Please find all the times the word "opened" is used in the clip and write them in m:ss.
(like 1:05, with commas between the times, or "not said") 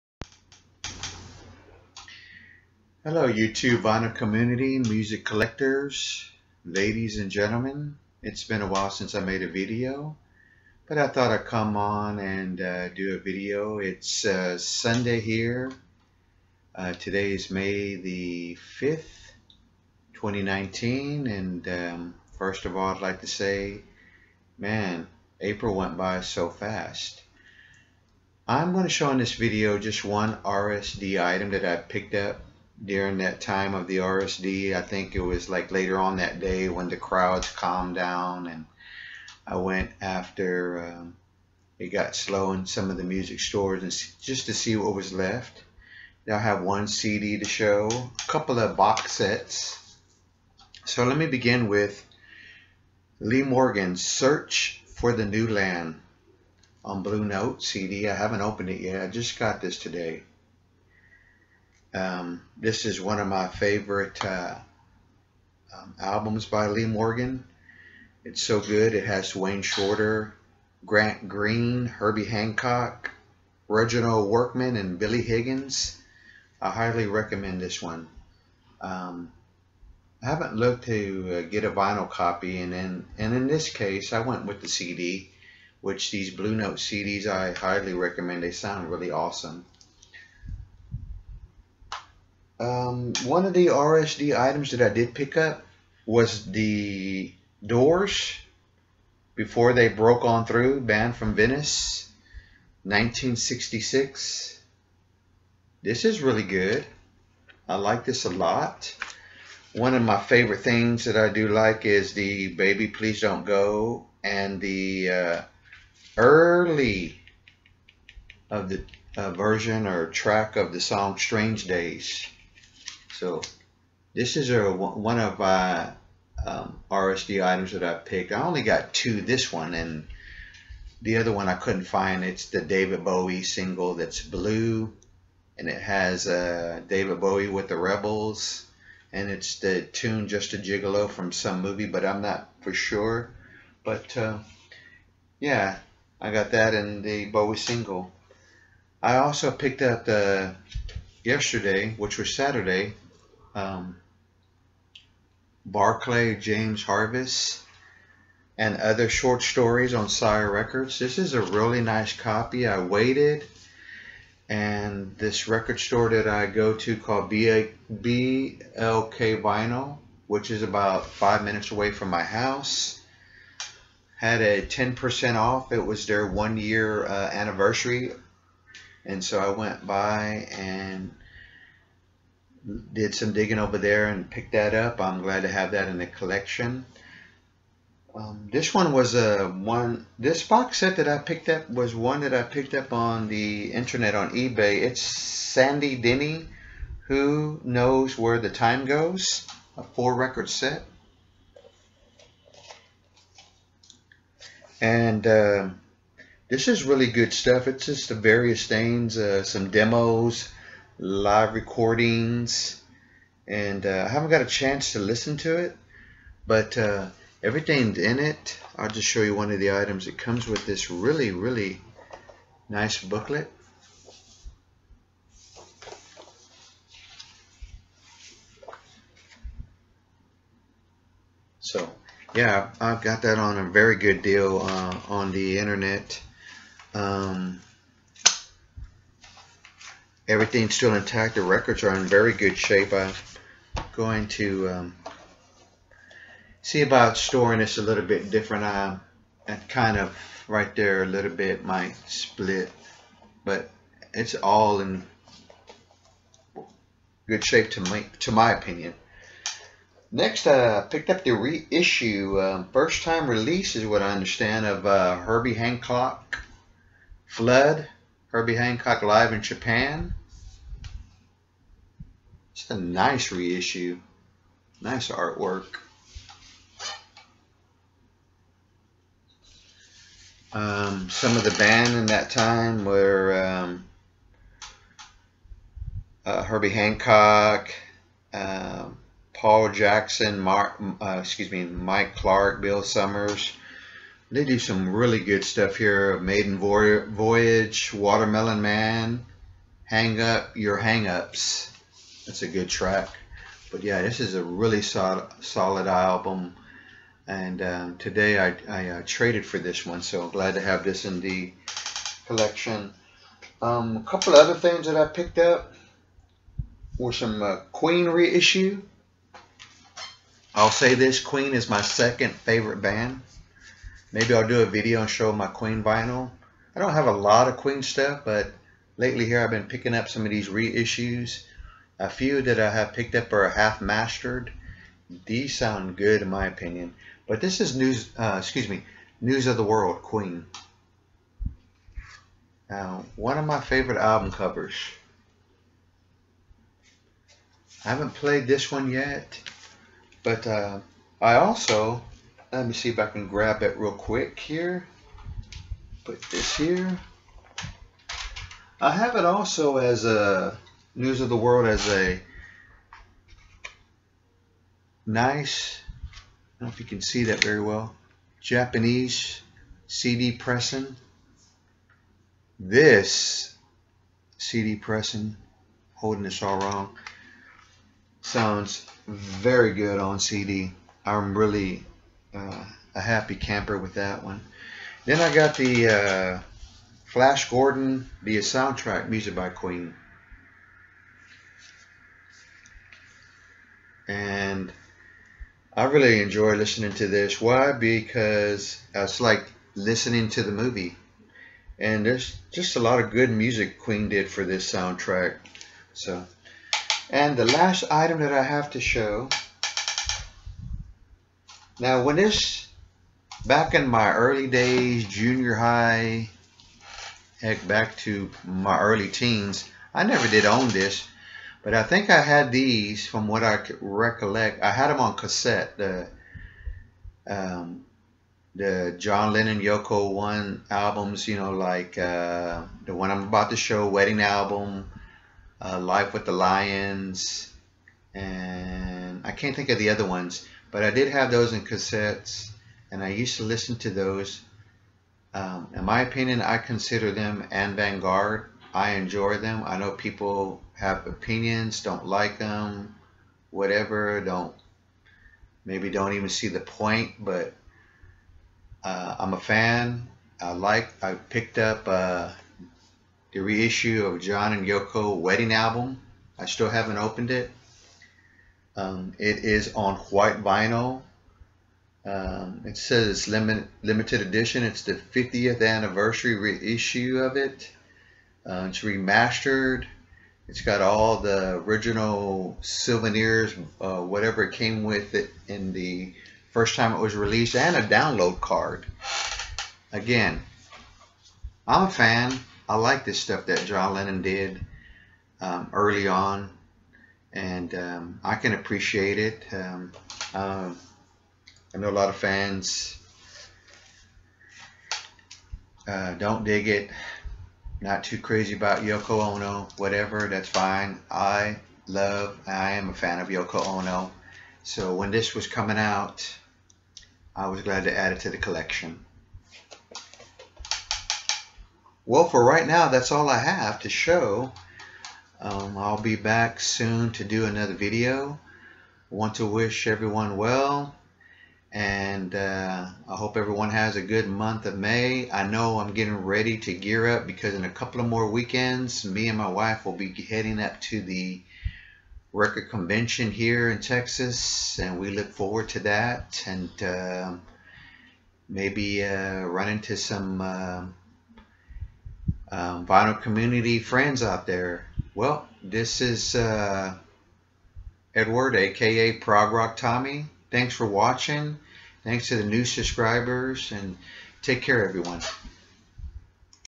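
0:58, 7:46.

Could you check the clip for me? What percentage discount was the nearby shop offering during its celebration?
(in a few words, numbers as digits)
10%.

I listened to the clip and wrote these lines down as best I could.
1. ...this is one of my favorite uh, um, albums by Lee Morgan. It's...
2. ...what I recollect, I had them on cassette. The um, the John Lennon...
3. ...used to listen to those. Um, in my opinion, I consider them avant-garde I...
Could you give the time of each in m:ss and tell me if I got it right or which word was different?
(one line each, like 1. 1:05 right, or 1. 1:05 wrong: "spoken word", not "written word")
1. 1:02 right
2. 7:03 right
3. 7:23 right.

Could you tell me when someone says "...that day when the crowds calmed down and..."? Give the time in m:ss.
0:36.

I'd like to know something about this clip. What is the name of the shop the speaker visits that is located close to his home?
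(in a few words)
BLK Vinyl.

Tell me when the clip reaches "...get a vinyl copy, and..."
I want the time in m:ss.
1:21.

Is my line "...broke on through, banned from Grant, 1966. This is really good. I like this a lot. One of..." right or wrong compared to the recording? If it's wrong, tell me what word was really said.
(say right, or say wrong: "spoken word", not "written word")
wrong: "Venice", not "Grant".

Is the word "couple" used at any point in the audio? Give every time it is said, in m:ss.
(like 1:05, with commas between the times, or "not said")
0:48, 5:14, 8:57.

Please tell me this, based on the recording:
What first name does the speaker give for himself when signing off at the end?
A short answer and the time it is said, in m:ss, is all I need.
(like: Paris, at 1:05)
Edward, at 9:18.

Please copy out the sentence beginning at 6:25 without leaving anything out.
Then I got the uh, Flash Gordon, the soundtrack music by Queen.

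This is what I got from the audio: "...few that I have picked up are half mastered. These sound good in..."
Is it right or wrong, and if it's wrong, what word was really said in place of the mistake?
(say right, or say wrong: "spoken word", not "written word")
right.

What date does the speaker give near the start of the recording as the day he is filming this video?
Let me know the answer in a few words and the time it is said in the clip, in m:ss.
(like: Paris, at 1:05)
May 5th, 2019, at 0:17.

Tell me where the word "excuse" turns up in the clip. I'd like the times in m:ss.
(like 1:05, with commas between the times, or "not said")
4:51, 5:38.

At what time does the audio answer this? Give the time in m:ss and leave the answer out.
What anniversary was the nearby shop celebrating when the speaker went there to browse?
2:56.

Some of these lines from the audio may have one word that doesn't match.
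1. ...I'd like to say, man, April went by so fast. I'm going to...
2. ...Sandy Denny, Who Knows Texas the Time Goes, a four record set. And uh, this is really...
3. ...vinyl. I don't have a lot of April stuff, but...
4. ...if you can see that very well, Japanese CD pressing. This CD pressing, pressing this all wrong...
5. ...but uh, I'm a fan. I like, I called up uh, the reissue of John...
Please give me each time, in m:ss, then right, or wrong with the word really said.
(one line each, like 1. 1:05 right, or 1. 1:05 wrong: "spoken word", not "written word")
1. 0:22 right
2. 3:15 wrong: "Where", not "Texas"
3. 5:25 wrong: "Queen", not "April"
4. 6:06 wrong: "holding", not "pressing"
5. 7:37 wrong: "picked", not "called".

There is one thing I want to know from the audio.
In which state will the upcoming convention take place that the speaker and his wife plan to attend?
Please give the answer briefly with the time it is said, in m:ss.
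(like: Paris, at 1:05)
Texas, at 9:03.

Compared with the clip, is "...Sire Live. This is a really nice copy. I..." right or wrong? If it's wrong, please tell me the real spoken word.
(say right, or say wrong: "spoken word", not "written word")
wrong: "Records", not "Live".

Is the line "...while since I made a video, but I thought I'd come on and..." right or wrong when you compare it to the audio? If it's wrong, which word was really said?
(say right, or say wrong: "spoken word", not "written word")
right.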